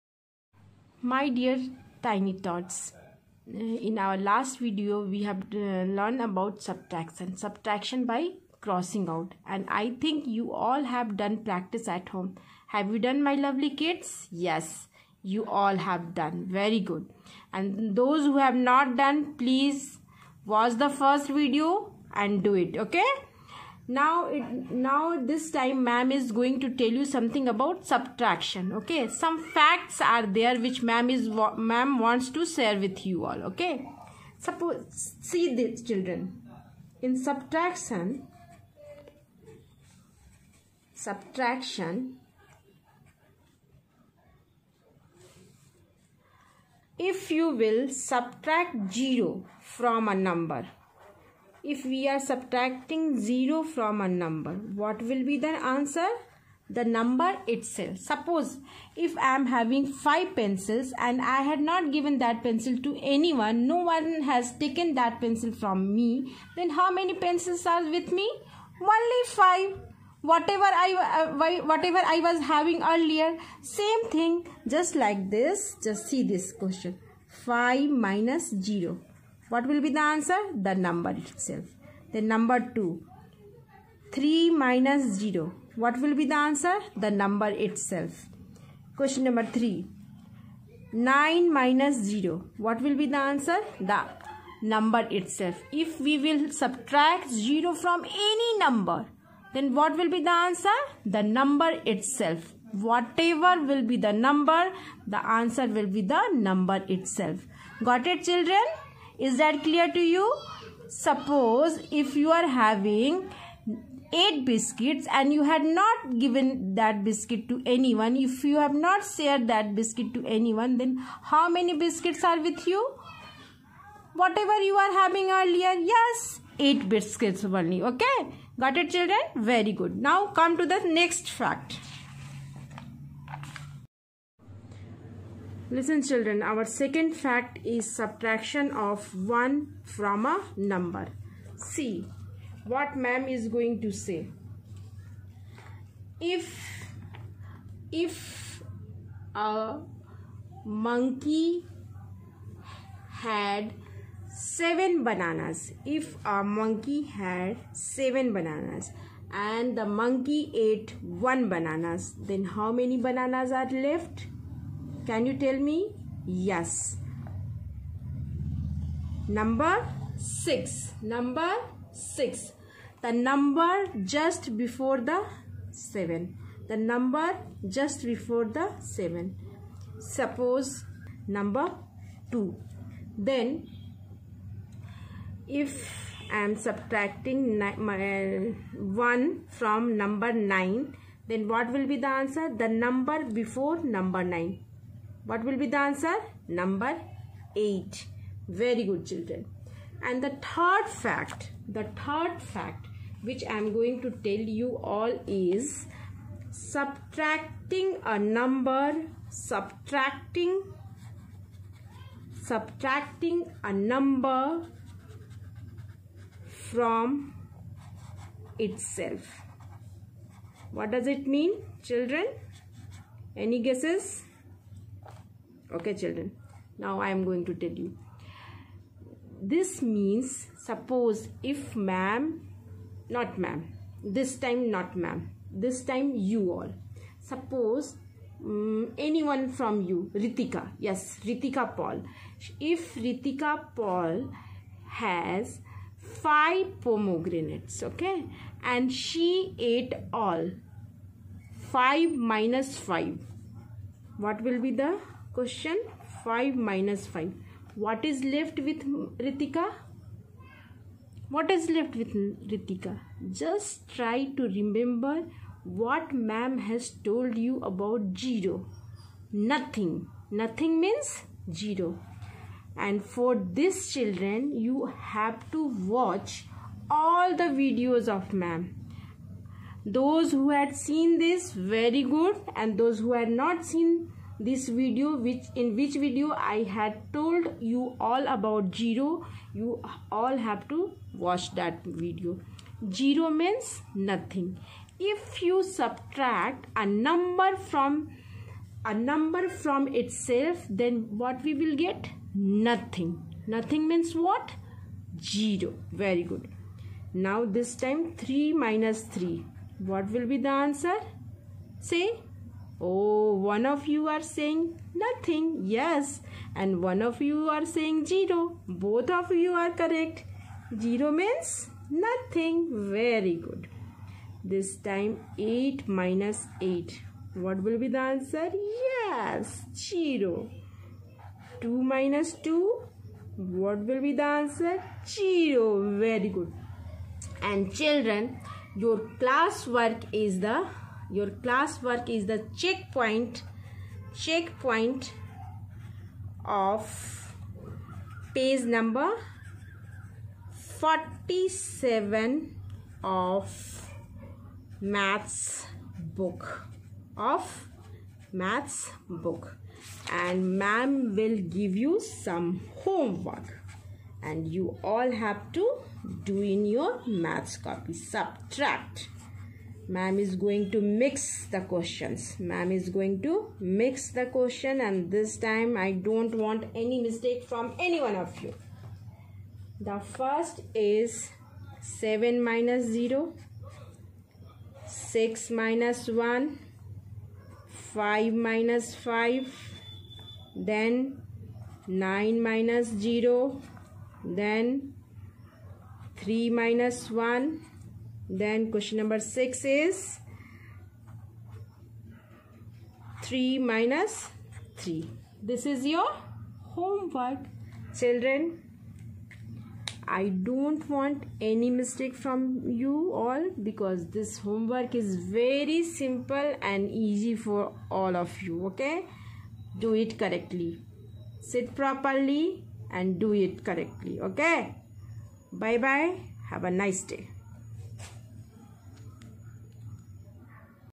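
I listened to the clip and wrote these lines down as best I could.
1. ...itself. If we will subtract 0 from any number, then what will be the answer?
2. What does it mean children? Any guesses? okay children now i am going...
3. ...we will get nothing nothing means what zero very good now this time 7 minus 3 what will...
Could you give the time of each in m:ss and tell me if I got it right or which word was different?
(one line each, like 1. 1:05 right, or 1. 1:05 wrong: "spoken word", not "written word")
1. 1:35 right
2. 3:40 right
3. 5:01 wrong: "3", not "7".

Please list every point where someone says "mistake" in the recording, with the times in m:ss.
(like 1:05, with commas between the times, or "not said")
6:17, 6:51.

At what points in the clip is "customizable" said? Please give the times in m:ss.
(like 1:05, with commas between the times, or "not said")
not said.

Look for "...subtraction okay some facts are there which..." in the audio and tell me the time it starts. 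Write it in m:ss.
0:27.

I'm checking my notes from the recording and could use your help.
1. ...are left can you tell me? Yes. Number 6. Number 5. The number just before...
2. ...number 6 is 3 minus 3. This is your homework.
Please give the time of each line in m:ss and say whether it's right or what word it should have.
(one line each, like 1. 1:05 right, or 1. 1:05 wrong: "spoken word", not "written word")
1. 2:43 wrong: "6", not "5"
2. 6:38 right.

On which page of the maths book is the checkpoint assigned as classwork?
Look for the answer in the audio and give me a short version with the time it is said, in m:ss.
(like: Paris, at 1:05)
47, at 5:50.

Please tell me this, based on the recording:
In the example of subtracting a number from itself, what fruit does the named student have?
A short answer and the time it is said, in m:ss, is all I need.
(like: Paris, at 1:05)
Pomegranates, at 4:06.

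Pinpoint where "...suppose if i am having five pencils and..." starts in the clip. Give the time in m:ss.
0:57.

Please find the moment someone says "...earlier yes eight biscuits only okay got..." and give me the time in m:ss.
2:05.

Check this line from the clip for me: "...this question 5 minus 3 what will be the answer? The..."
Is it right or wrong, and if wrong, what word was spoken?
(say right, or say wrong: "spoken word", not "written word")
wrong: "0", not "3".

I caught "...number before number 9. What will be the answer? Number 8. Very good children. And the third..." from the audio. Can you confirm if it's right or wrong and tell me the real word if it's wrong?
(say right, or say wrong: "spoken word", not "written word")
right.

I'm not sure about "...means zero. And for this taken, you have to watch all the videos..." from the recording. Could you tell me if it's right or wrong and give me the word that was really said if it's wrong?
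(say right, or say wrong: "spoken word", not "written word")
wrong: "children", not "taken".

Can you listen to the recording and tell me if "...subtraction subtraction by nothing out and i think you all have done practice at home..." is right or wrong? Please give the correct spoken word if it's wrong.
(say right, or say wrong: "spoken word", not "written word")
wrong: "crossing", not "nothing".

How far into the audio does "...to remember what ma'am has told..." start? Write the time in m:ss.
4:24.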